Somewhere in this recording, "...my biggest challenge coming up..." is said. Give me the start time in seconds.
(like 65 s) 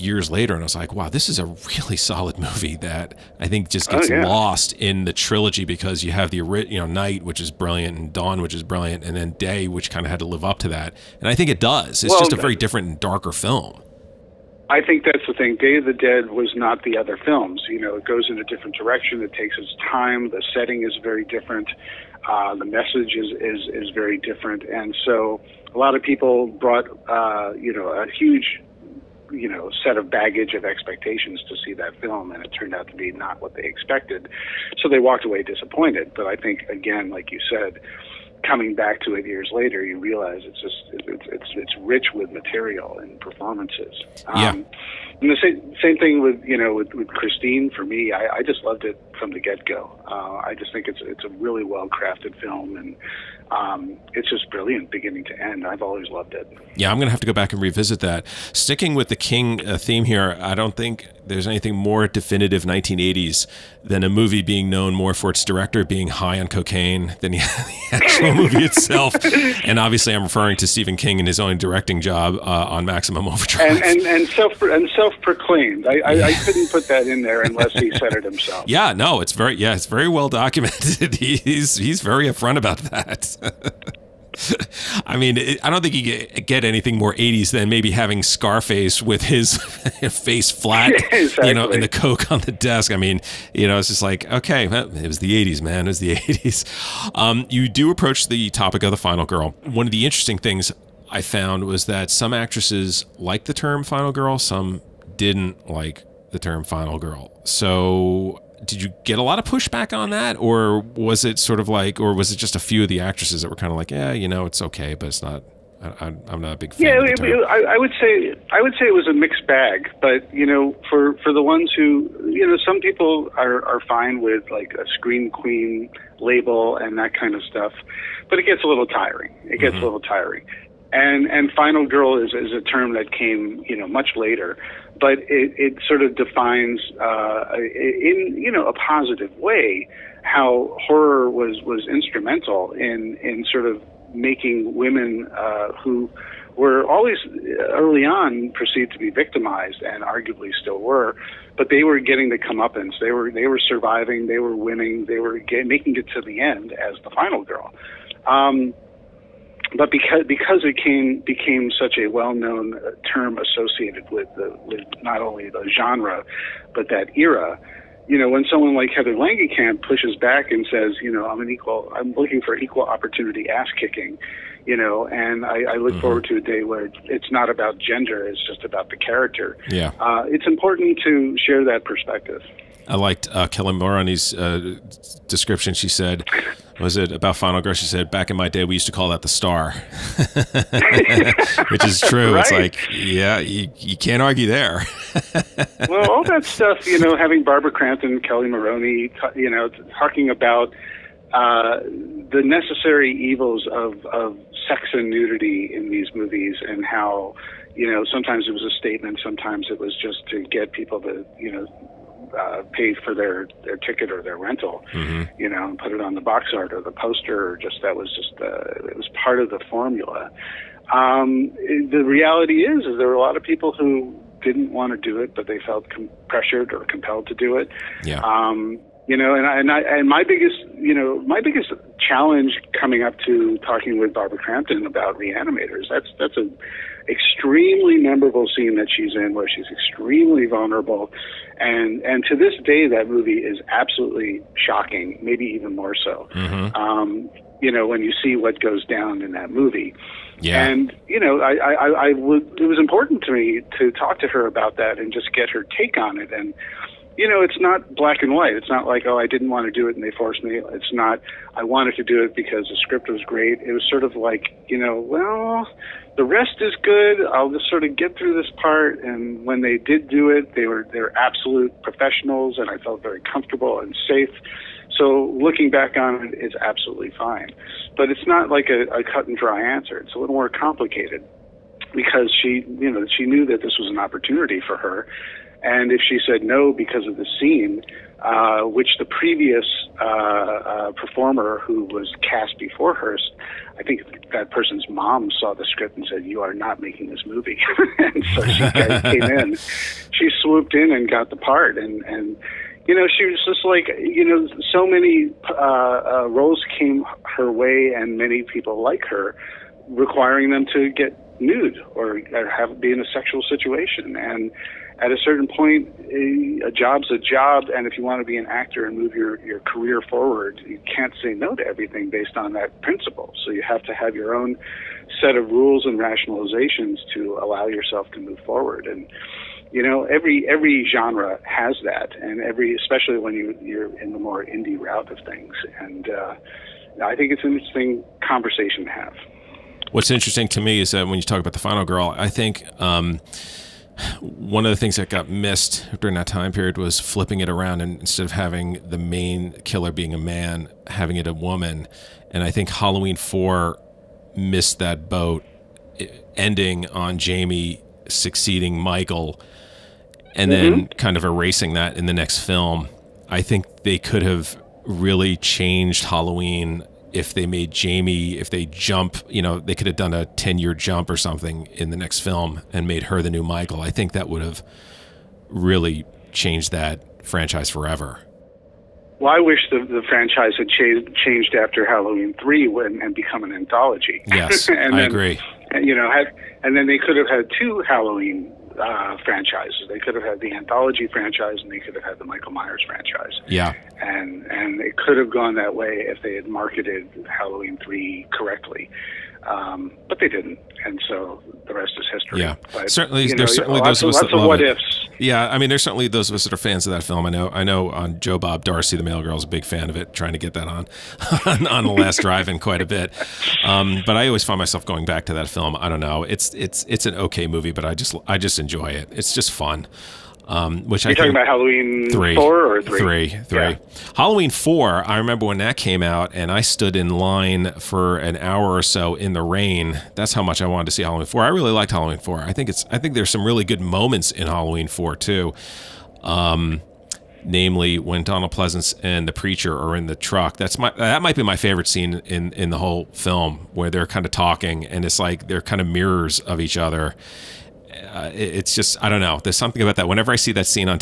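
231 s.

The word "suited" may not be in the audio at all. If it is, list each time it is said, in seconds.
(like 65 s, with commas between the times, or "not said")
not said.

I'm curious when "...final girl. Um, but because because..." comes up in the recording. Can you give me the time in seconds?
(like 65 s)
157 s.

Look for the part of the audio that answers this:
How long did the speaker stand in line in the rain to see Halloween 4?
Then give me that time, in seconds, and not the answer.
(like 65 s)
428 s.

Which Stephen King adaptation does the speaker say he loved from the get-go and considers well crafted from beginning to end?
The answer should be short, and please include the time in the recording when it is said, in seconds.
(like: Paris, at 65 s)
Christine, at 47 s.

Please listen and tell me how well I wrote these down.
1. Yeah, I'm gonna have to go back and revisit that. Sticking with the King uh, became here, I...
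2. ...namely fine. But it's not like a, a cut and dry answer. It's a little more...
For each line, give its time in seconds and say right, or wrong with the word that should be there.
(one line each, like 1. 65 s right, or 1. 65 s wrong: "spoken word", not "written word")
1. 56 s wrong: "theme", not "became"
2. 276 s wrong: "absolutely", not "namely".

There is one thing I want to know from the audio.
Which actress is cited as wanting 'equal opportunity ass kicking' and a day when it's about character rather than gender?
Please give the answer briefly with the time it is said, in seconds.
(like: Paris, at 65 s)
Heather Langenkamp, at 168 s.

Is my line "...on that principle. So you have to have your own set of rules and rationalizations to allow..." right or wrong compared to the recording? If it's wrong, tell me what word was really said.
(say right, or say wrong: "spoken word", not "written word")
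right.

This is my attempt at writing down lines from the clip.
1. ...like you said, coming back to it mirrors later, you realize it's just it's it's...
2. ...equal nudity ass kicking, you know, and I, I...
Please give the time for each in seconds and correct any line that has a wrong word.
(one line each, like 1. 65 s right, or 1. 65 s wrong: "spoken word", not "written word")
1. 37 s wrong: "years", not "mirrors"
2. 172 s wrong: "opportunity", not "nudity".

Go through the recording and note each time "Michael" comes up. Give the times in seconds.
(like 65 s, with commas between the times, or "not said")
358 s, 373 s, 392 s.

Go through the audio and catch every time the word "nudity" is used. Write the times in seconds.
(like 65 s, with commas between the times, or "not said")
205 s.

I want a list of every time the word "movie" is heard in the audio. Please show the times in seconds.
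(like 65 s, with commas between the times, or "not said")
2 s, 64 s, 68 s, 206 s, 243 s, 249 s, 297 s, 417 s.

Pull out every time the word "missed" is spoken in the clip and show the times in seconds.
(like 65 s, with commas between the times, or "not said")
345 s, 354 s.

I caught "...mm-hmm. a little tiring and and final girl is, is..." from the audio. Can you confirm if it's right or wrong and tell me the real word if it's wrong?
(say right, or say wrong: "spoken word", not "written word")
right.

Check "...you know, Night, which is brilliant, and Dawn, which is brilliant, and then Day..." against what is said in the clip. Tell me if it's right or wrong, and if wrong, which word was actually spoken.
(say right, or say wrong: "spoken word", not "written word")
right.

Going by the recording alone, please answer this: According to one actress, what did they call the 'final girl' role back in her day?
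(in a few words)
the star.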